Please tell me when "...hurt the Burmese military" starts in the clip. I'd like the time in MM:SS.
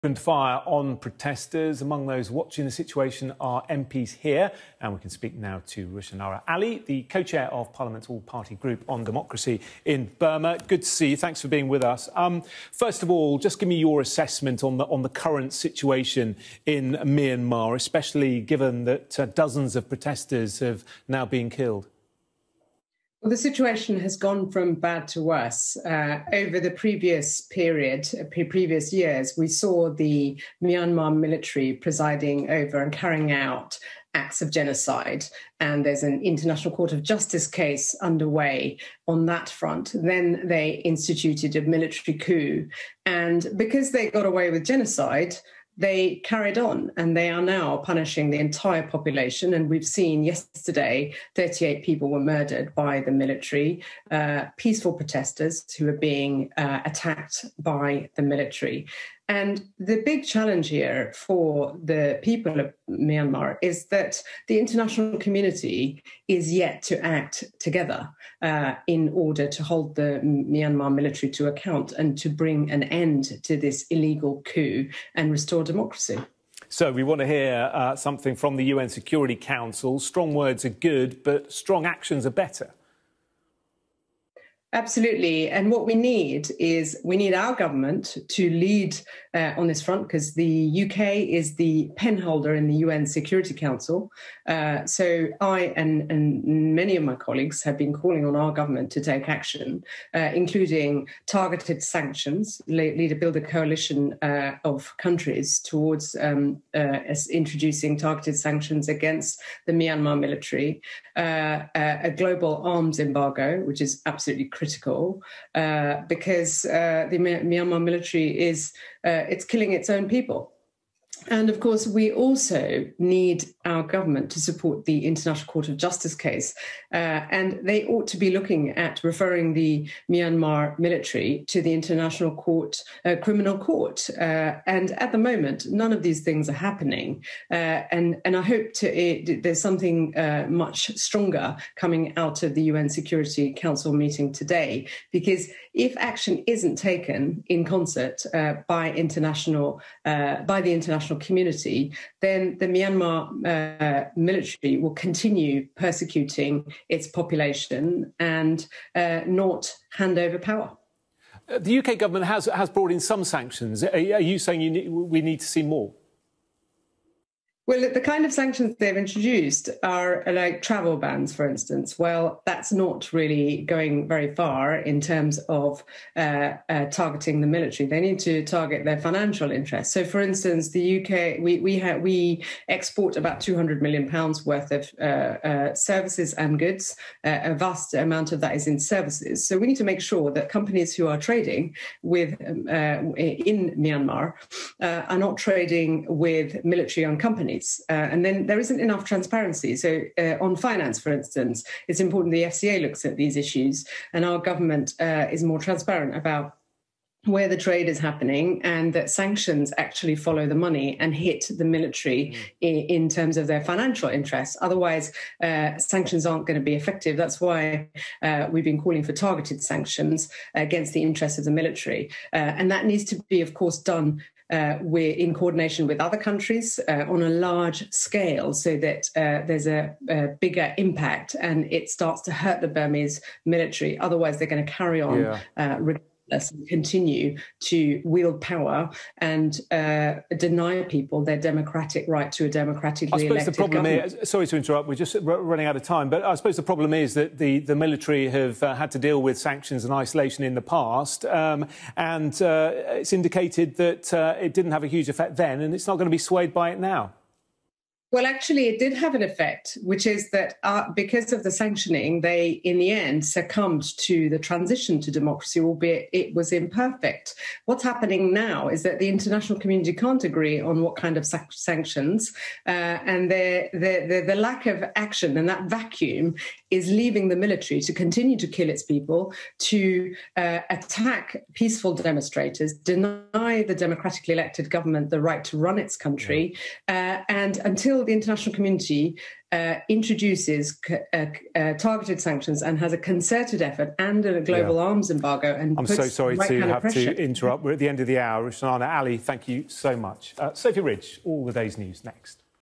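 03:52.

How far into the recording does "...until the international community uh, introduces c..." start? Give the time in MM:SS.
04:47.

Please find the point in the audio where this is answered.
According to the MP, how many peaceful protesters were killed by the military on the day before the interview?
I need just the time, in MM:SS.
00:51.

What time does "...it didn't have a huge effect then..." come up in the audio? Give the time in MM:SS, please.
04:14.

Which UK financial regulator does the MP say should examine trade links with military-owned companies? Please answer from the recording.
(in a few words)
FCA.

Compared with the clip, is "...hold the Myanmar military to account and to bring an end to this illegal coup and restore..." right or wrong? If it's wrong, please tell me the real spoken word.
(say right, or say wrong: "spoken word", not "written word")
right.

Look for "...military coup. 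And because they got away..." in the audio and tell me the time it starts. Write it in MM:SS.
00:41.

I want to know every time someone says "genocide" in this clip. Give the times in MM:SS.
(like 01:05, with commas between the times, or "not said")
00:34, 00:44.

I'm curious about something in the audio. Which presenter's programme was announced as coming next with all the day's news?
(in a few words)
Sophy Ridge.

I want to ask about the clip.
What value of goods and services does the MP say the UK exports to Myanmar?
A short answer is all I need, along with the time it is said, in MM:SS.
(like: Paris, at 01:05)
200 million pounds, at 03:03.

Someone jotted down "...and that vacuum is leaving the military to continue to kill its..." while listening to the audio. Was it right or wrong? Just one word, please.
right.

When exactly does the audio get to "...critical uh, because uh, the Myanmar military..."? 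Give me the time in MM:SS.
01:54.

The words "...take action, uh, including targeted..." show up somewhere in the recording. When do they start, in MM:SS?
01:39.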